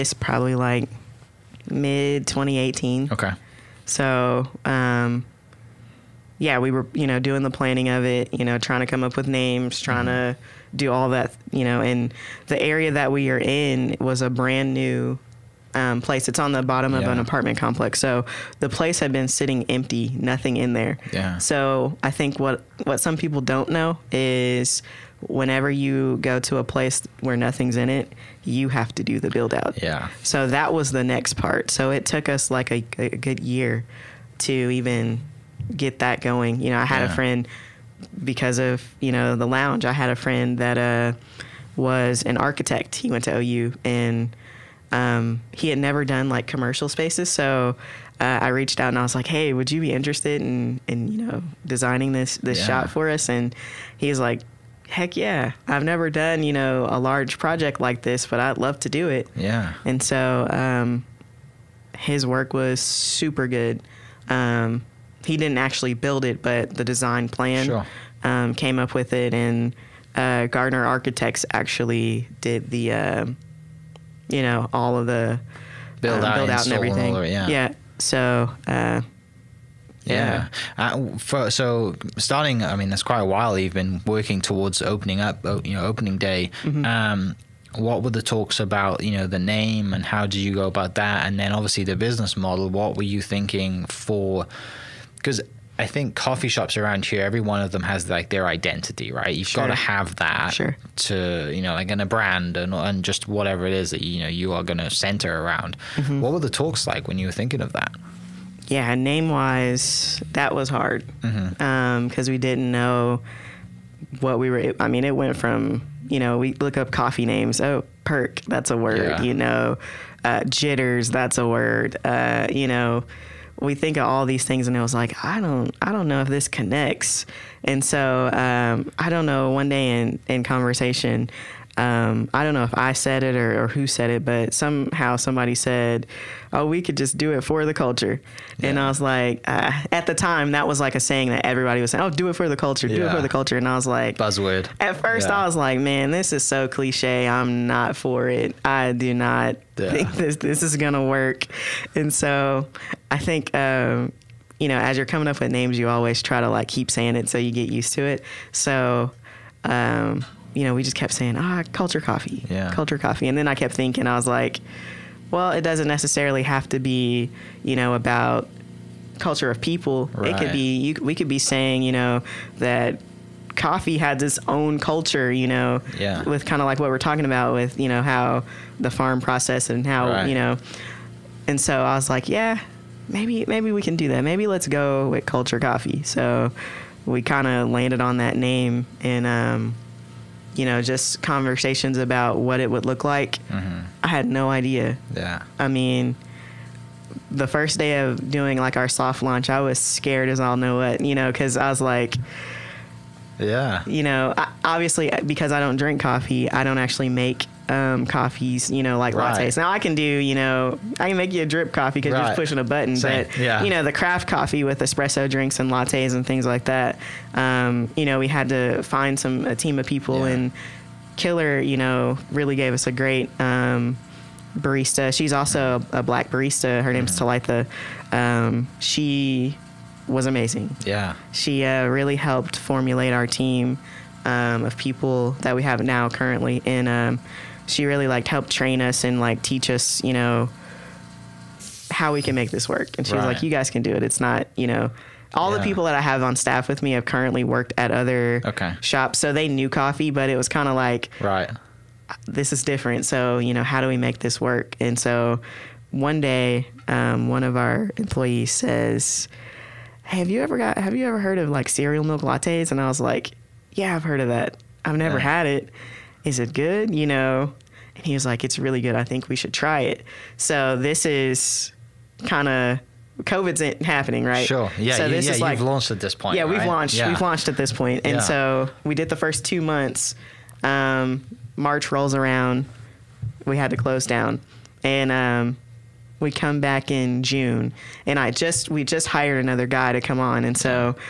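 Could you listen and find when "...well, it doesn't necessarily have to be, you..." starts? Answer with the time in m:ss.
2:45.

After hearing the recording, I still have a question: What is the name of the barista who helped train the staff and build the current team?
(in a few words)
Talitha.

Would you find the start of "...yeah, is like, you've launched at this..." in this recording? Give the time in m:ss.
4:35.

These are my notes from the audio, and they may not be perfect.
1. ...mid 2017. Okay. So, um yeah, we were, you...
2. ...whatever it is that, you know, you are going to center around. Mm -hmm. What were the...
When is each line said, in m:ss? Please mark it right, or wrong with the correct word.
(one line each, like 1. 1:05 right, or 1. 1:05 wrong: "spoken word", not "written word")
1. 0:01 wrong: "2018", not "2017"
2. 1:43 right.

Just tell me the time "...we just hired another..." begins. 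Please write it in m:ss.
4:48.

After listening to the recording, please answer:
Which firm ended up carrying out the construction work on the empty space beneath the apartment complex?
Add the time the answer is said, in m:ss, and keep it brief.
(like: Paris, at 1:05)
Gardner Architects, at 1:10.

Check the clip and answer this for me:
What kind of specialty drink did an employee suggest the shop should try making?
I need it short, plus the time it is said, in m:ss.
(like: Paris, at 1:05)
Cereal milk lattes, at 4:21.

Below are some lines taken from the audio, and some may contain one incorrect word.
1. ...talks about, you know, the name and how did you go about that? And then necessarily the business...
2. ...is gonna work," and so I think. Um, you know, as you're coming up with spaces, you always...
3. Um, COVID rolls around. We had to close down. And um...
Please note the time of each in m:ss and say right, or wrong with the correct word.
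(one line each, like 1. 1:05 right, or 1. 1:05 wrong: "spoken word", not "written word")
1. 1:28 wrong: "obviously", not "necessarily"
2. 2:30 wrong: "names", not "spaces"
3. 4:40 wrong: "March", not "COVID".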